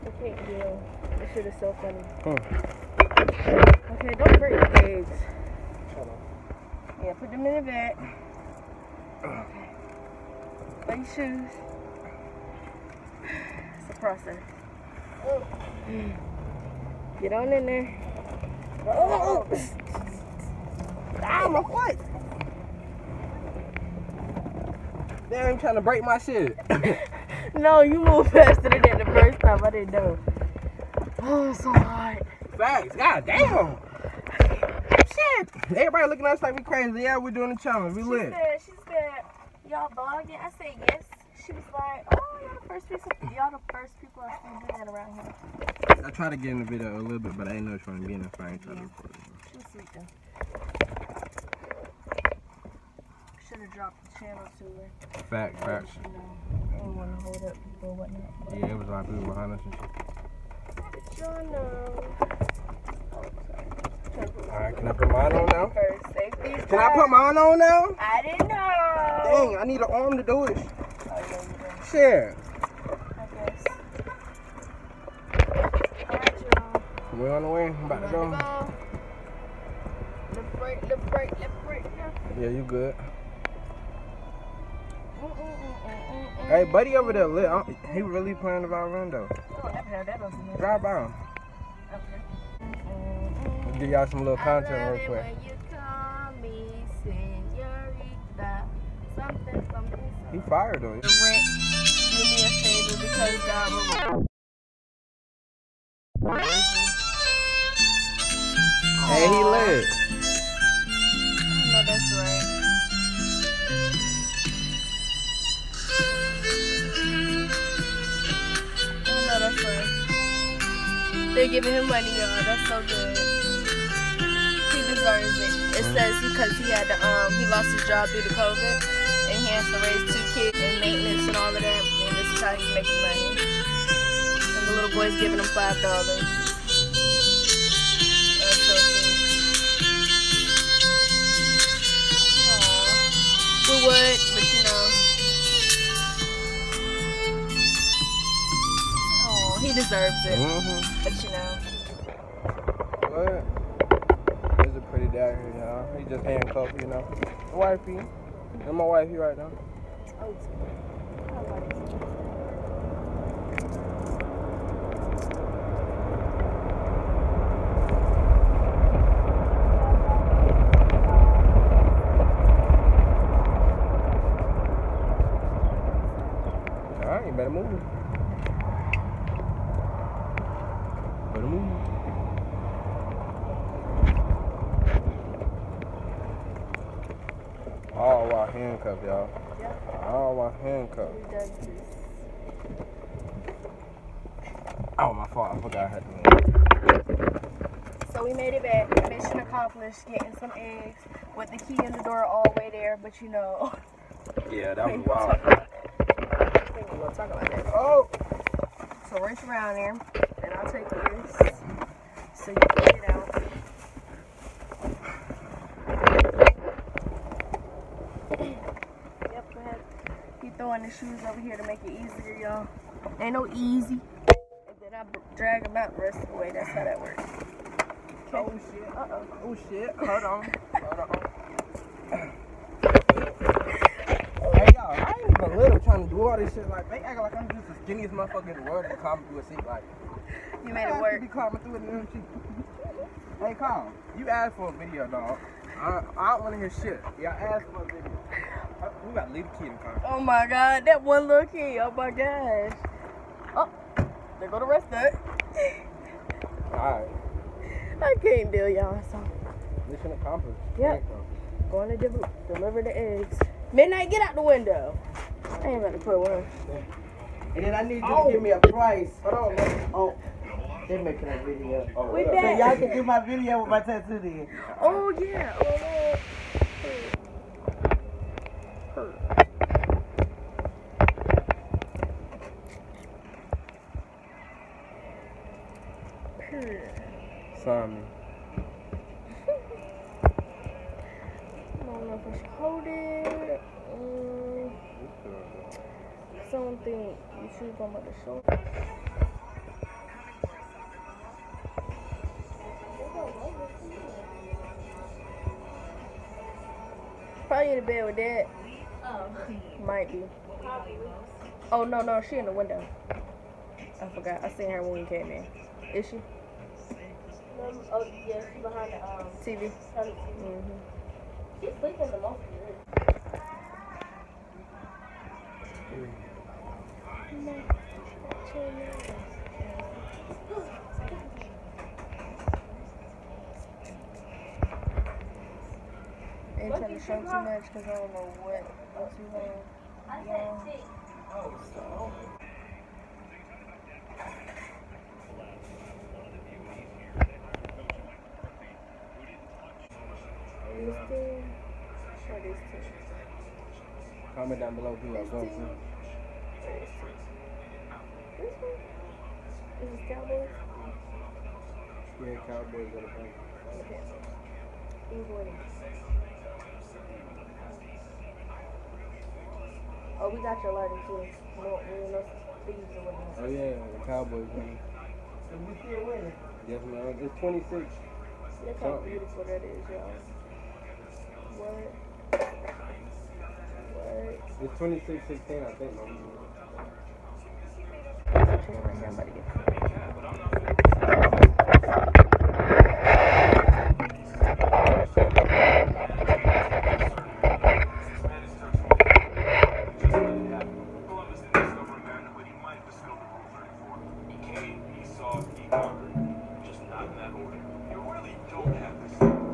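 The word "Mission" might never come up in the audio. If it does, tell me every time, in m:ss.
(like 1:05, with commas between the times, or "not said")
3:19, 4:19.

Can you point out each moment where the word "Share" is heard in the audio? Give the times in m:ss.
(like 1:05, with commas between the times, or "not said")
1:11.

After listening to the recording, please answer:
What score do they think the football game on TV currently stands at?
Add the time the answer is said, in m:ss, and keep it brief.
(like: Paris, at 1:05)
26-16, at 6:24.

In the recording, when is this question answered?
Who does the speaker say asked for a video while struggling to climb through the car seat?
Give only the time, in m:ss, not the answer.
4:03.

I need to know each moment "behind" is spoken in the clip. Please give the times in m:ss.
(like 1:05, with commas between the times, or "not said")
0:59, 5:18.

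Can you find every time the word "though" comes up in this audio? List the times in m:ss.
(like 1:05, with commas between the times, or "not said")
0:49, 1:29.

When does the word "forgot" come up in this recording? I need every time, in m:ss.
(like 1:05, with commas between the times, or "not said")
3:15, 5:14.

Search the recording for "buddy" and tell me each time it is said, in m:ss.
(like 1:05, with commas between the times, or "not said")
1:26.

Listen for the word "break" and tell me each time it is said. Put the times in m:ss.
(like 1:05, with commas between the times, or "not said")
0:04, 0:25.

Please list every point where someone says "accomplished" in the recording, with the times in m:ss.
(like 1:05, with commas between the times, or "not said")
3:19, 4:20.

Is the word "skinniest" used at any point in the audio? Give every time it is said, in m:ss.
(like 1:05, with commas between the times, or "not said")
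3:57.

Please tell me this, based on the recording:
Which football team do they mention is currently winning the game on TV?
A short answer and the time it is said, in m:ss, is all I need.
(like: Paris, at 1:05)
Cowboys, at 6:13.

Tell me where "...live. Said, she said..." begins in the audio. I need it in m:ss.
0:38.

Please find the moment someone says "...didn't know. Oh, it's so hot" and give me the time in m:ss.
0:29.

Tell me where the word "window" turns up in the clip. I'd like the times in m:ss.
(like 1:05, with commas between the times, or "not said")
4:24, 5:12.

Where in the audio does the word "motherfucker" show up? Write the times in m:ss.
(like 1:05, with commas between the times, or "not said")
3:58.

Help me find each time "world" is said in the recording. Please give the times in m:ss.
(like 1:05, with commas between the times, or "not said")
3:58.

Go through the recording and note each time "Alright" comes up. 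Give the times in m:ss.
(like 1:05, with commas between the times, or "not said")
1:01, 4:16.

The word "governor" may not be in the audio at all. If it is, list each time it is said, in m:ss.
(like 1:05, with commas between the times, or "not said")
not said.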